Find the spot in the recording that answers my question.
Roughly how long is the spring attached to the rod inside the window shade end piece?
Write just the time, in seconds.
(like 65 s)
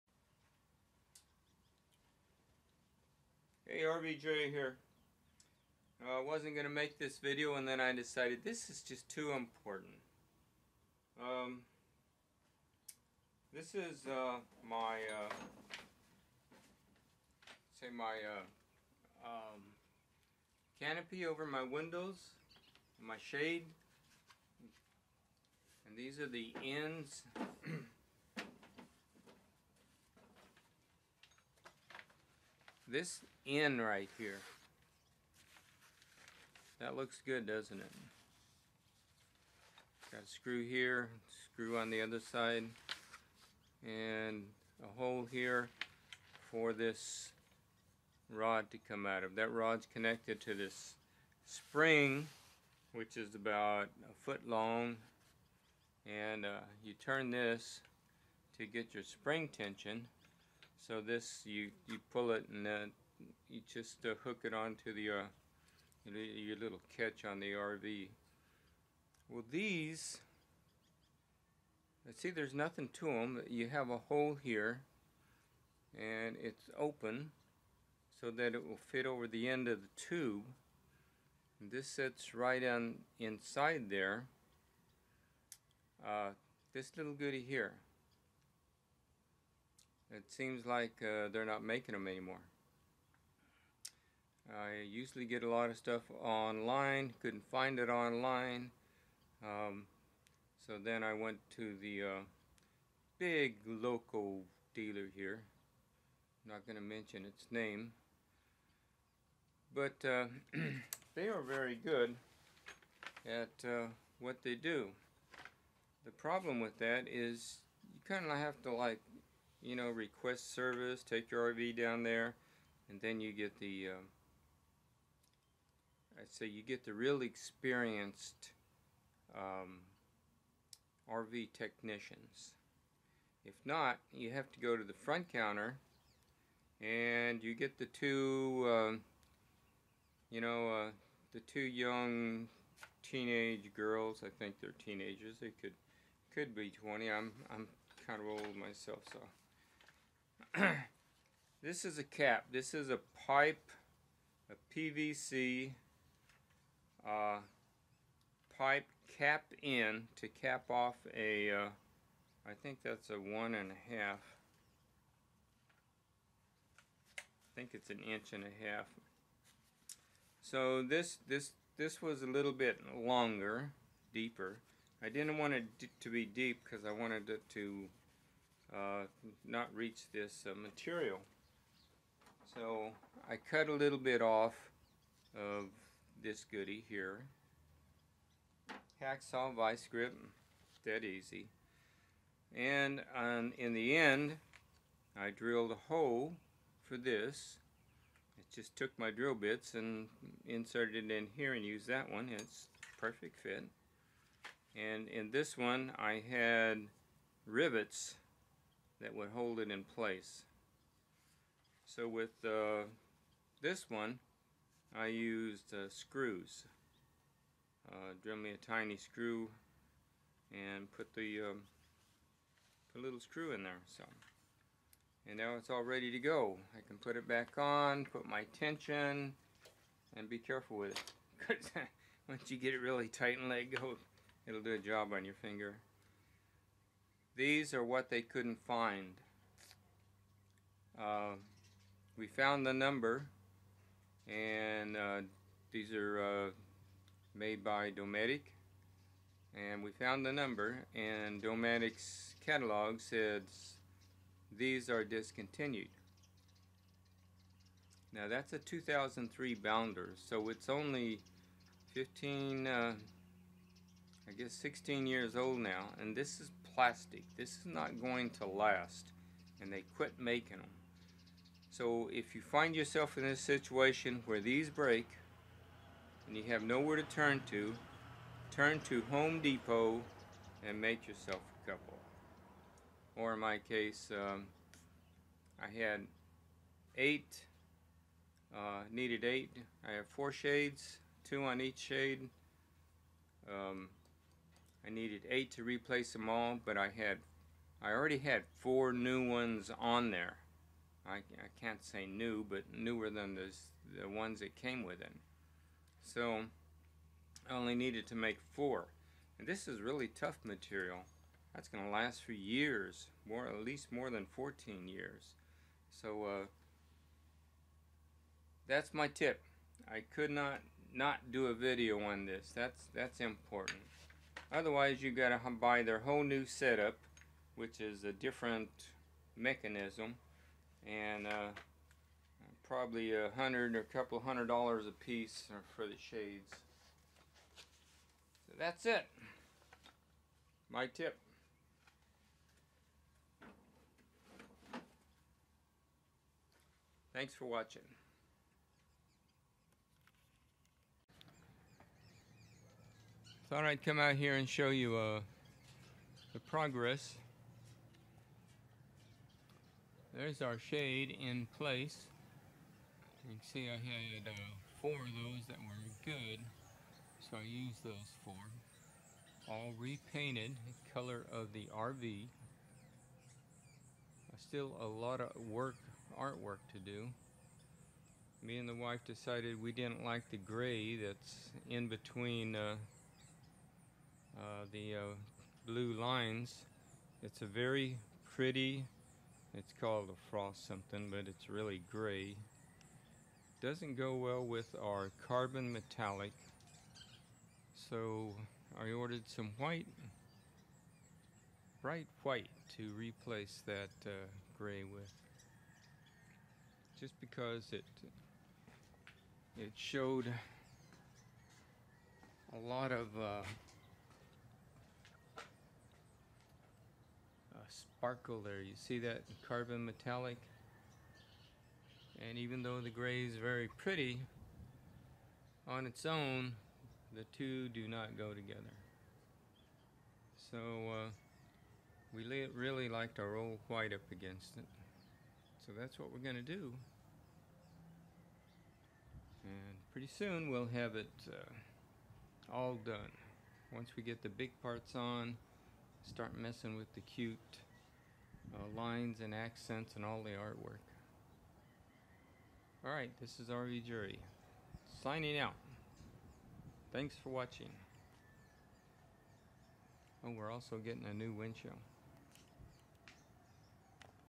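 53 s.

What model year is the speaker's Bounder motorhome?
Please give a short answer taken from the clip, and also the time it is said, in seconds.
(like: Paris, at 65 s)
2003, at 258 s.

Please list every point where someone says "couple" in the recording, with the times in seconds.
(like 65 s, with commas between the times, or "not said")
281 s, 333 s.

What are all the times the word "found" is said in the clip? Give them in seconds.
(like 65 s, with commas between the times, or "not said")
242 s, 249 s.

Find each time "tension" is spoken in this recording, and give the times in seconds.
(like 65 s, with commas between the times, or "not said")
59 s, 228 s.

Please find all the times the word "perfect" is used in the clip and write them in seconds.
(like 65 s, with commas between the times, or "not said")
202 s.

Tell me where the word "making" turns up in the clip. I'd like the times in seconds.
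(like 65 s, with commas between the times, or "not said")
91 s, 270 s.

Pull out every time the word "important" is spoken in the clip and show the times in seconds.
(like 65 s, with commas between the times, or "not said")
9 s, 323 s.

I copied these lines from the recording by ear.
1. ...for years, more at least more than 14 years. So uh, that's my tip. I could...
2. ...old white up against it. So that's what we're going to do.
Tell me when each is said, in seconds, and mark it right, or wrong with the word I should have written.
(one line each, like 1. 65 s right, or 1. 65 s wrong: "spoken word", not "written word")
1. 312 s right
2. 433 s right.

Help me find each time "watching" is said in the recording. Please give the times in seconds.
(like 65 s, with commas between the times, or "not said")
347 s, 457 s.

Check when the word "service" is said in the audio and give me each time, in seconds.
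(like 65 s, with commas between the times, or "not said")
120 s.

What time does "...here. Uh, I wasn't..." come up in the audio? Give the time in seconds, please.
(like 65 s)
4 s.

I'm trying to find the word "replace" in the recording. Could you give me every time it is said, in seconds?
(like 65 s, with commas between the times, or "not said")
295 s, 402 s.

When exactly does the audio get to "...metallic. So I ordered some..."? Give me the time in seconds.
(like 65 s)
395 s.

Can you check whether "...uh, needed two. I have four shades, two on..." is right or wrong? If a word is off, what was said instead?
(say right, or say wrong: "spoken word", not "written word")
wrong: "eight", not "two".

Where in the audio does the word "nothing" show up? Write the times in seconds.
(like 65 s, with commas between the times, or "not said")
72 s.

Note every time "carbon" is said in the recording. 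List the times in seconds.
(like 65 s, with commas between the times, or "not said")
395 s, 419 s.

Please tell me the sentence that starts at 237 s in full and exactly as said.
These are what they couldn't find.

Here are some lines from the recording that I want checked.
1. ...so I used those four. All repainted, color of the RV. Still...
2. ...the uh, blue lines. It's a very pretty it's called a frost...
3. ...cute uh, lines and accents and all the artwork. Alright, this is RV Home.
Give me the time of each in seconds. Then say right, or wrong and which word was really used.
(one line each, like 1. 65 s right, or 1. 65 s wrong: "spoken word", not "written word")
1. 367 s right
2. 384 s right
3. 447 s wrong: "Jerry", not "Home".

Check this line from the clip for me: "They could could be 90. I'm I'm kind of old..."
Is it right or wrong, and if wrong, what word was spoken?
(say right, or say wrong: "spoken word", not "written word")
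wrong: "20", not "90".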